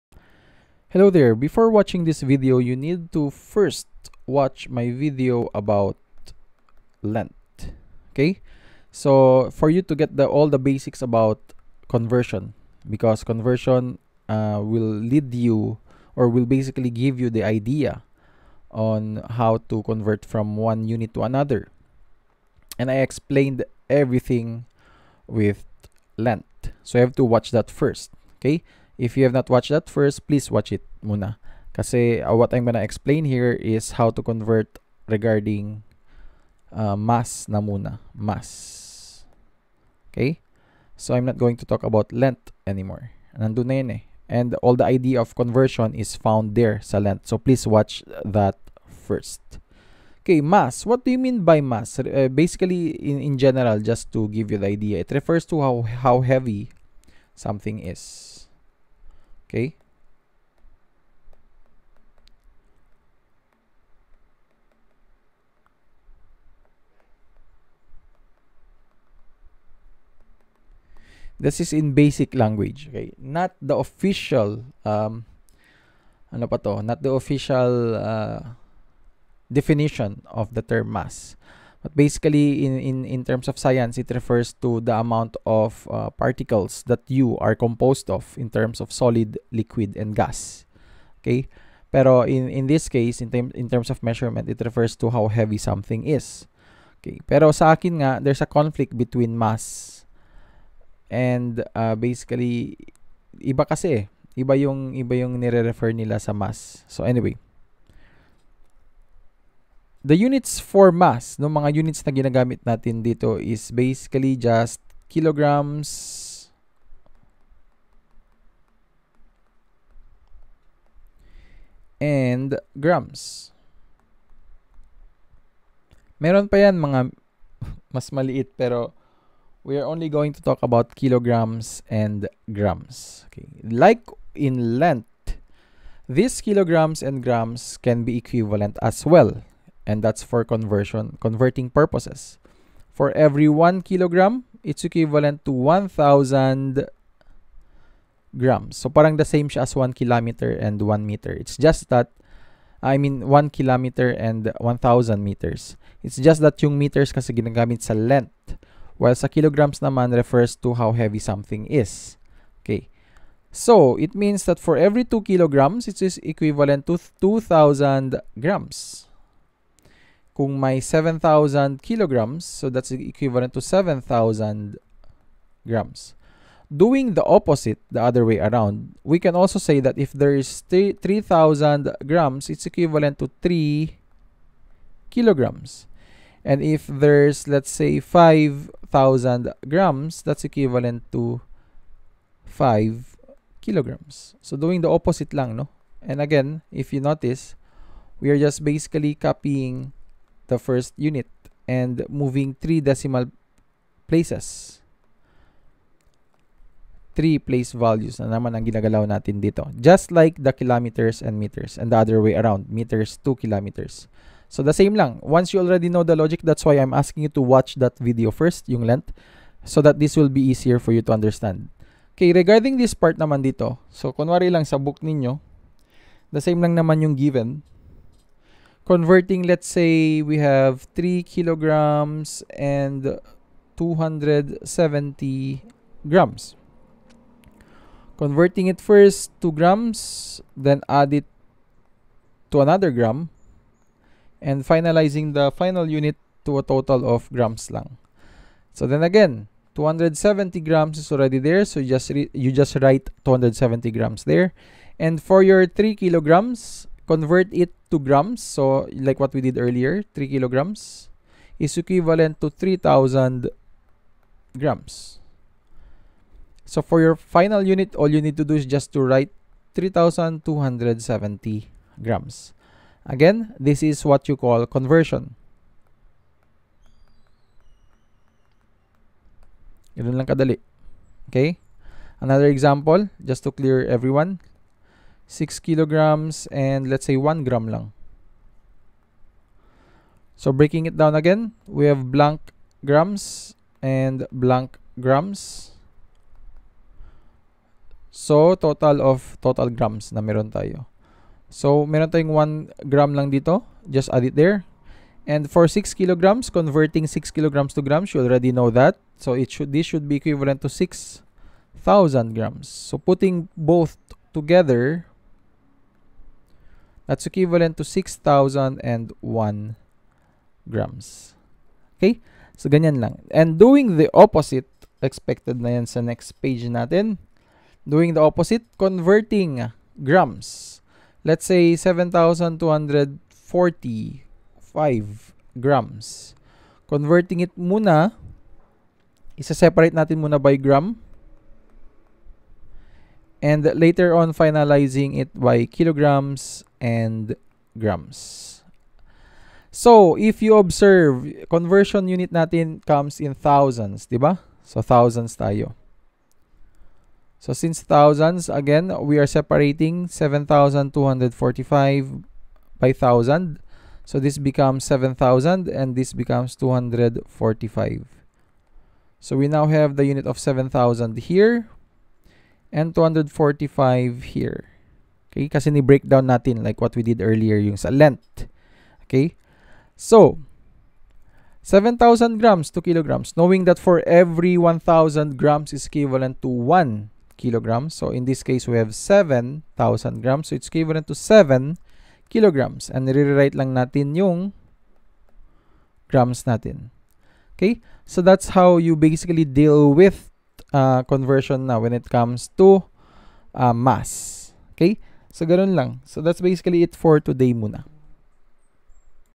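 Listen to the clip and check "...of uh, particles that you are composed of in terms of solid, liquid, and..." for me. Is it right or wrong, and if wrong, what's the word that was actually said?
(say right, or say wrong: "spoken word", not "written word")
right.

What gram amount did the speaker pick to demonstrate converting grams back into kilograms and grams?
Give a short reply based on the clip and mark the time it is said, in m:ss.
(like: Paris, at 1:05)
7,245 grams, at 5:31.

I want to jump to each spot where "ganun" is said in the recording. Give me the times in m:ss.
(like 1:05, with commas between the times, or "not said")
4:39, 6:45.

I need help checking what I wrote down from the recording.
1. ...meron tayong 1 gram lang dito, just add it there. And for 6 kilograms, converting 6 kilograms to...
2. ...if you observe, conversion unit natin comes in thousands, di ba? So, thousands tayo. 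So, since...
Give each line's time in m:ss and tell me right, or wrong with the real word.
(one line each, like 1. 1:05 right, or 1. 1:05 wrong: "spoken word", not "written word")
1. 5:01 right
2. 5:50 right.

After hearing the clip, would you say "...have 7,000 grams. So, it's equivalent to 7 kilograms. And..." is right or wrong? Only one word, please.
right.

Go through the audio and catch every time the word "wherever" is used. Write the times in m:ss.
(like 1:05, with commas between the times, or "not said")
not said.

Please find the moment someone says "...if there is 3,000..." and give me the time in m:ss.
2:59.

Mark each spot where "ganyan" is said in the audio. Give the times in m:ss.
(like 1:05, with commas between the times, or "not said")
5:22.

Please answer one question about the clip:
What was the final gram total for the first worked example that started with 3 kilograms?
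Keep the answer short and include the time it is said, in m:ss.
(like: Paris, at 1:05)
3,270 grams, at 4:29.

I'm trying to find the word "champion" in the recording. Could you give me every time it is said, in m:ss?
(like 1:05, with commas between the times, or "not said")
not said.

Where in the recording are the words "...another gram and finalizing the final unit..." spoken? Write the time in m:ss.
4:02.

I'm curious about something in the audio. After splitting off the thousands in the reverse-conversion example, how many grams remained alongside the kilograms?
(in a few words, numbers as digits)
245.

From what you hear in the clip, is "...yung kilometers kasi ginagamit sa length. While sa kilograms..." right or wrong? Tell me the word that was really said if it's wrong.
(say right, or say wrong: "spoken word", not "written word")
wrong: "meters", not "kilometers".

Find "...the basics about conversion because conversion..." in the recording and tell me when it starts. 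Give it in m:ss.
0:10.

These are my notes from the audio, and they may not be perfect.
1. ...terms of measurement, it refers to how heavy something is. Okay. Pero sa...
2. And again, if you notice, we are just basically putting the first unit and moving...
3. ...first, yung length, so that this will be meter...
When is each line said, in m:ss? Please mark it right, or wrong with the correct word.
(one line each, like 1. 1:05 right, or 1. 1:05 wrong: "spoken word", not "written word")
1. 1:33 right
2. 3:16 wrong: "copying", not "putting"
3. 3:38 wrong: "easier", not "meter".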